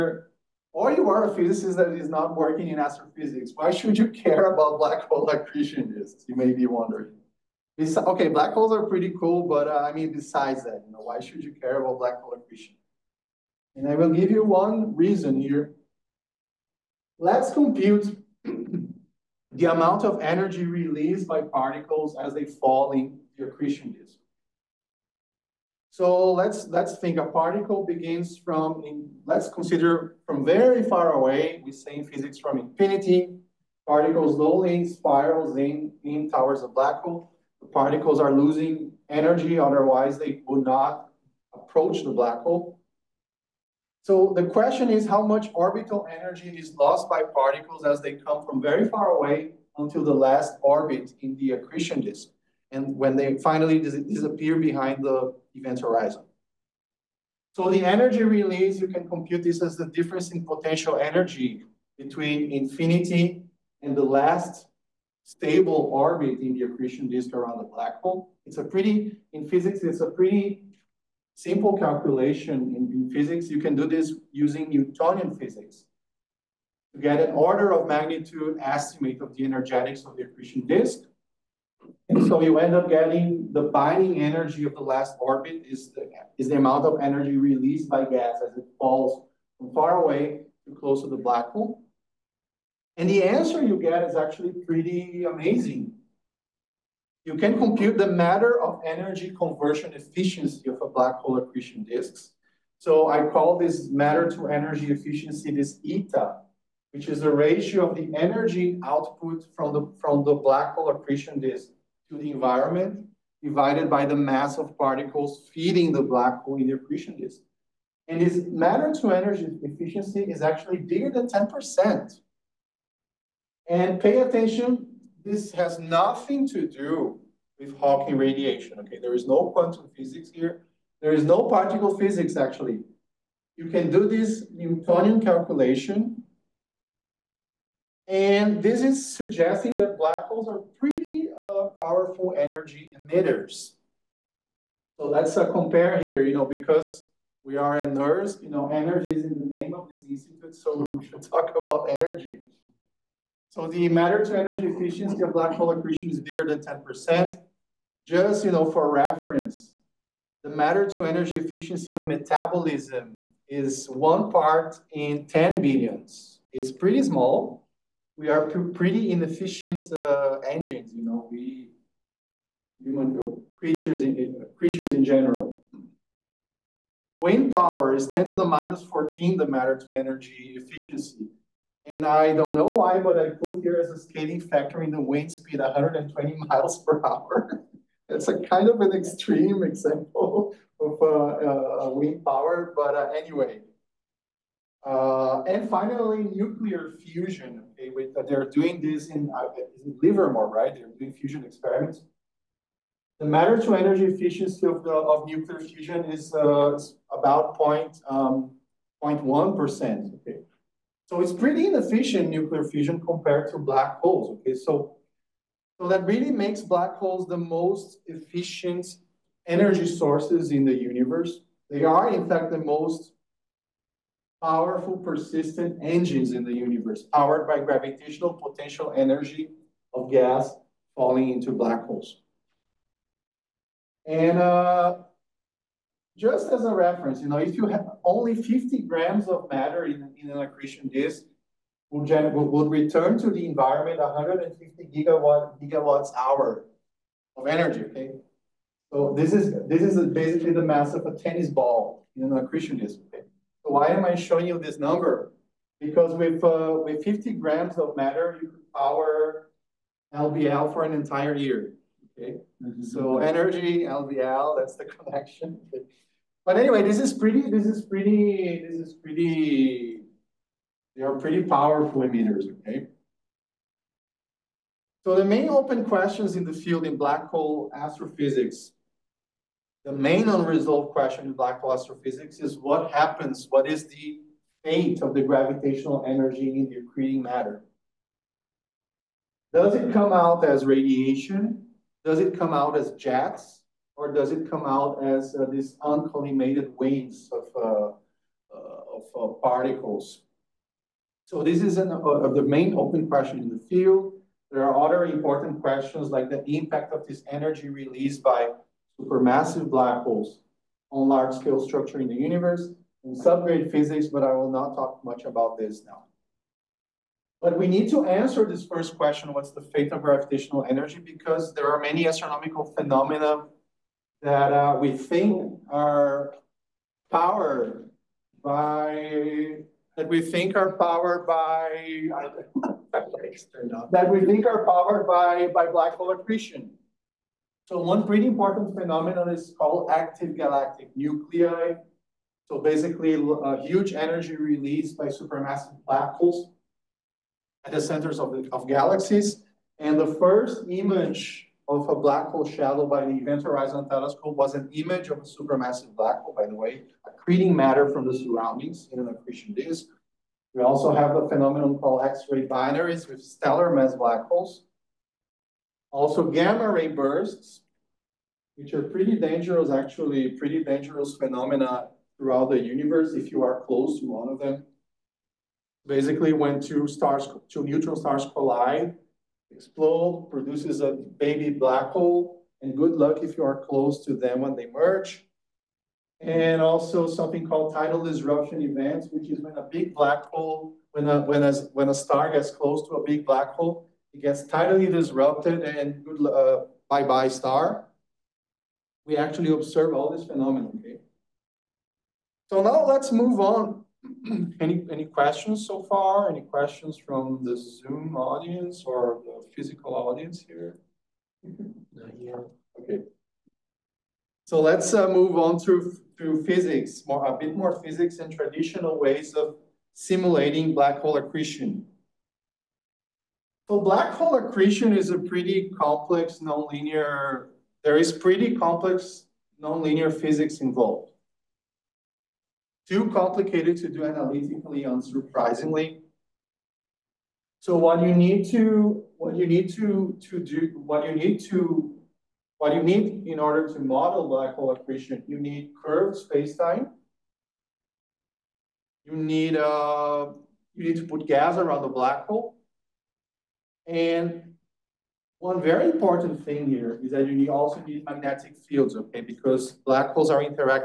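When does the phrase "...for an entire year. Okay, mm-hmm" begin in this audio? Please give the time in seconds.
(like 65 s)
260 s.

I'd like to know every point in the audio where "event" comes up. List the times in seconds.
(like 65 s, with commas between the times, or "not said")
55 s, 353 s, 388 s.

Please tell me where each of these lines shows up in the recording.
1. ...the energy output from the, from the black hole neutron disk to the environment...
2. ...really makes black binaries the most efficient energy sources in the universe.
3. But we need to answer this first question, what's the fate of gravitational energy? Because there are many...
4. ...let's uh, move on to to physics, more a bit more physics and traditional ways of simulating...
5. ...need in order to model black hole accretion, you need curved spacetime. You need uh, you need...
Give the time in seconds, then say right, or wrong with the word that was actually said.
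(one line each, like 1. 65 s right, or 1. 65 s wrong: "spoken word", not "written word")
1. 107 s wrong: "accretion", not "neutron"
2. 216 s wrong: "holes", not "binaries"
3. 317 s right
4. 414 s right
5. 442 s right.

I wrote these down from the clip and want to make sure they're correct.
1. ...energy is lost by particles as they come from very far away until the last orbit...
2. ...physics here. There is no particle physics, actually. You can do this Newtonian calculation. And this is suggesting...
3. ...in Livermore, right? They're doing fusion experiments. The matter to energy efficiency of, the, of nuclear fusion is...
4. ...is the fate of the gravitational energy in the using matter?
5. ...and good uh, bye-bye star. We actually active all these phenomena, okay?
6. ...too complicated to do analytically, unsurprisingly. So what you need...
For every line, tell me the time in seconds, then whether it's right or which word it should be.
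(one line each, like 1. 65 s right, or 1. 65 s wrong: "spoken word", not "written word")
1. 46 s right
2. 129 s right
3. 199 s right
4. 283 s wrong: "accreting", not "using"
5. 395 s wrong: "observe", not "active"
6. 432 s right.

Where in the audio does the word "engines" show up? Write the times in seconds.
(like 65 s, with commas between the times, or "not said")
170 s, 225 s.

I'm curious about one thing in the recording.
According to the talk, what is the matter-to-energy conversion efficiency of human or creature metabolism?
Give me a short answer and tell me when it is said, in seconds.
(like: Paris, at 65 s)
one part in 10 billion, at 163 s.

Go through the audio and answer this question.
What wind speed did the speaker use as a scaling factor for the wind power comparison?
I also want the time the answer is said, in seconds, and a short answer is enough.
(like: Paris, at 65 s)
120 miles per hour, at 185 s.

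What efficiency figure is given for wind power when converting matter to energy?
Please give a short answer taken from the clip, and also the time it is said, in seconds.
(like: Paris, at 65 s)
10 to the minus 14, at 178 s.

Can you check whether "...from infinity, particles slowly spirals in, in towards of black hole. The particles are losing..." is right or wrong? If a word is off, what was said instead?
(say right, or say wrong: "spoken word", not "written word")
right.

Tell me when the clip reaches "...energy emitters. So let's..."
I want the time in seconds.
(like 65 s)
142 s.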